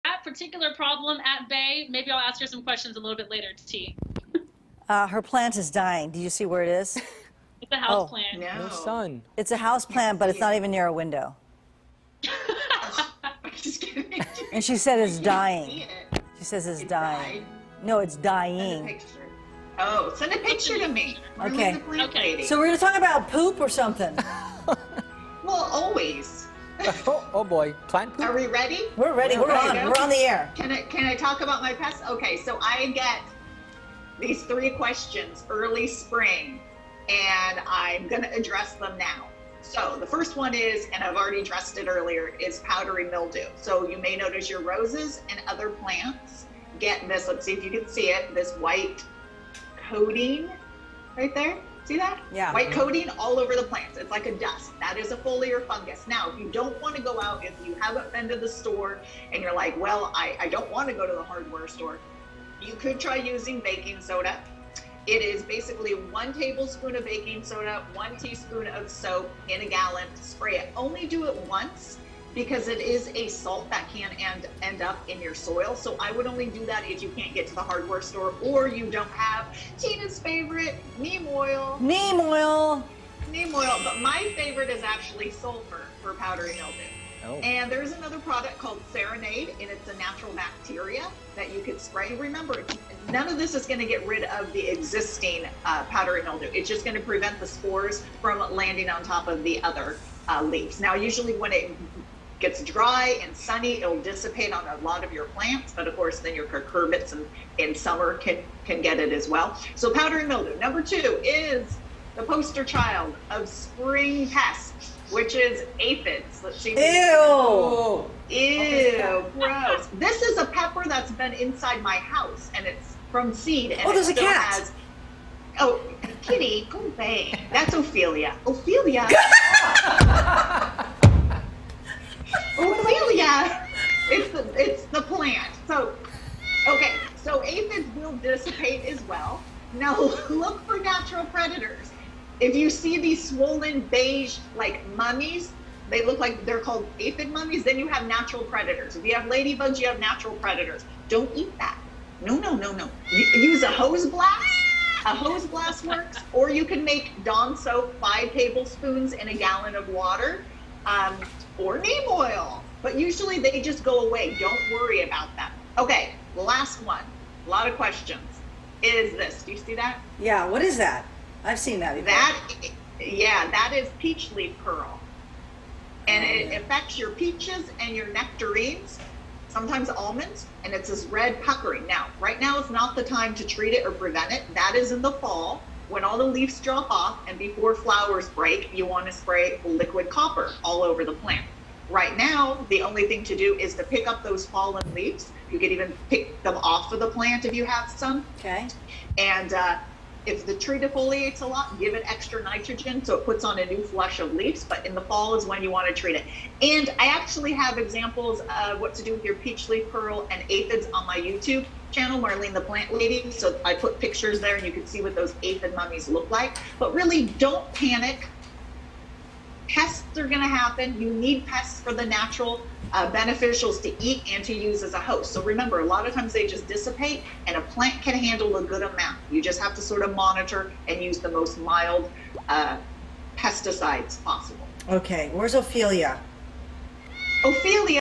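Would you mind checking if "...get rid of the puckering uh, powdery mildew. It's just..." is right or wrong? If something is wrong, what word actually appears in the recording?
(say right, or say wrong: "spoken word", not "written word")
wrong: "existing", not "puckering".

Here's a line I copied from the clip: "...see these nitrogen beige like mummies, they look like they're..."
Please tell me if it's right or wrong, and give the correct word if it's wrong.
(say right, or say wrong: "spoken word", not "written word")
wrong: "swollen", not "nitrogen".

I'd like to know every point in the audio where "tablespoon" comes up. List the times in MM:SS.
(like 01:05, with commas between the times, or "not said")
01:06, 02:38.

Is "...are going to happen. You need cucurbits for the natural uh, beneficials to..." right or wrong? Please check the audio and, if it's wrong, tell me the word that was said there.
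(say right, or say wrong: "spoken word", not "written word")
wrong: "pests", not "cucurbits".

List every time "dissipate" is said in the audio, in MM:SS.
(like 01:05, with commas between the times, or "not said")
01:44, 02:18, 03:46.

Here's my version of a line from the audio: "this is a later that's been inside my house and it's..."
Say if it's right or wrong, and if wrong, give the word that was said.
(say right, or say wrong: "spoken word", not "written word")
wrong: "pepper", not "later".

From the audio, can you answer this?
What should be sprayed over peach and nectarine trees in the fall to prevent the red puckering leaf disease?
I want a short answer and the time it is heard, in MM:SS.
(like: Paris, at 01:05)
Liquid copper, at 03:09.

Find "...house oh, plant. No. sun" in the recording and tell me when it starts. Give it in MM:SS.
00:07.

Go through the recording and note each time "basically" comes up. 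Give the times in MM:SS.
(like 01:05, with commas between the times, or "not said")
01:05.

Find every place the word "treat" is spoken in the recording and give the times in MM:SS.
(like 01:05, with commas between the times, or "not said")
03:03, 03:25.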